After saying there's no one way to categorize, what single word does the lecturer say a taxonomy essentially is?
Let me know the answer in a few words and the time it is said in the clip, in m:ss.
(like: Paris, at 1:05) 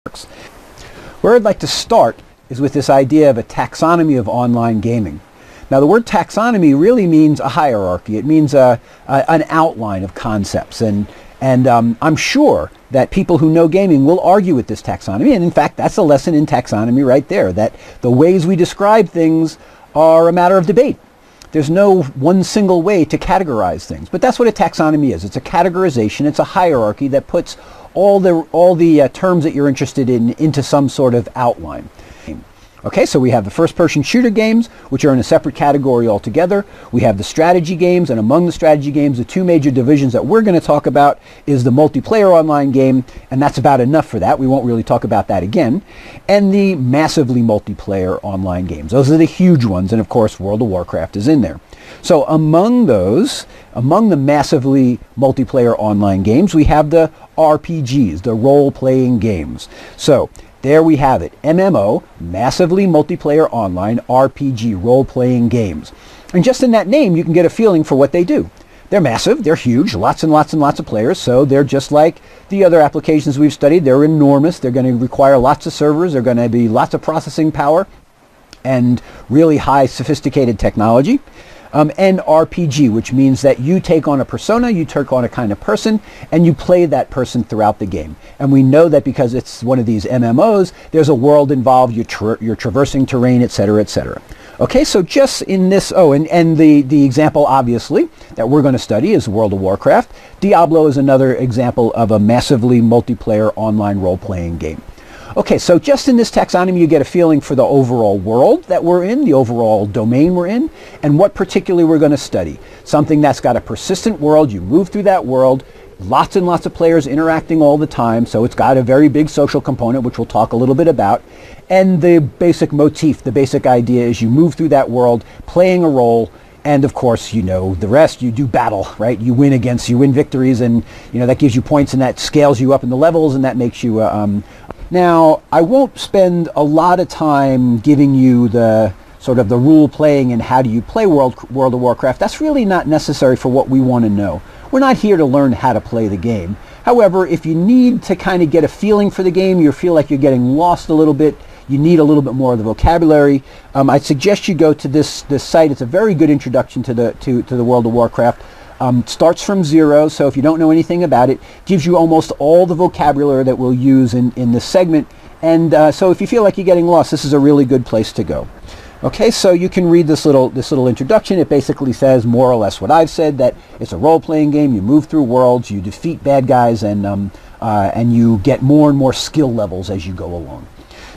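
a categorization, at 0:25.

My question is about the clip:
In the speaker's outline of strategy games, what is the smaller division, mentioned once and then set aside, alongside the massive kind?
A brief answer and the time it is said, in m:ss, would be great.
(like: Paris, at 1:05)
multiplayer online game, at 0:41.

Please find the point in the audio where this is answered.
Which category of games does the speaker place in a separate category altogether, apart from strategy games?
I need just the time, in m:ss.
0:33.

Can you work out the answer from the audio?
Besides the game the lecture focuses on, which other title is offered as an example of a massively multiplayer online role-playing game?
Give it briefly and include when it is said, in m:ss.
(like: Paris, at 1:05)
Diablo, at 1:40.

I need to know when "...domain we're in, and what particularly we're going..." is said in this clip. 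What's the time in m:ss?
1:49.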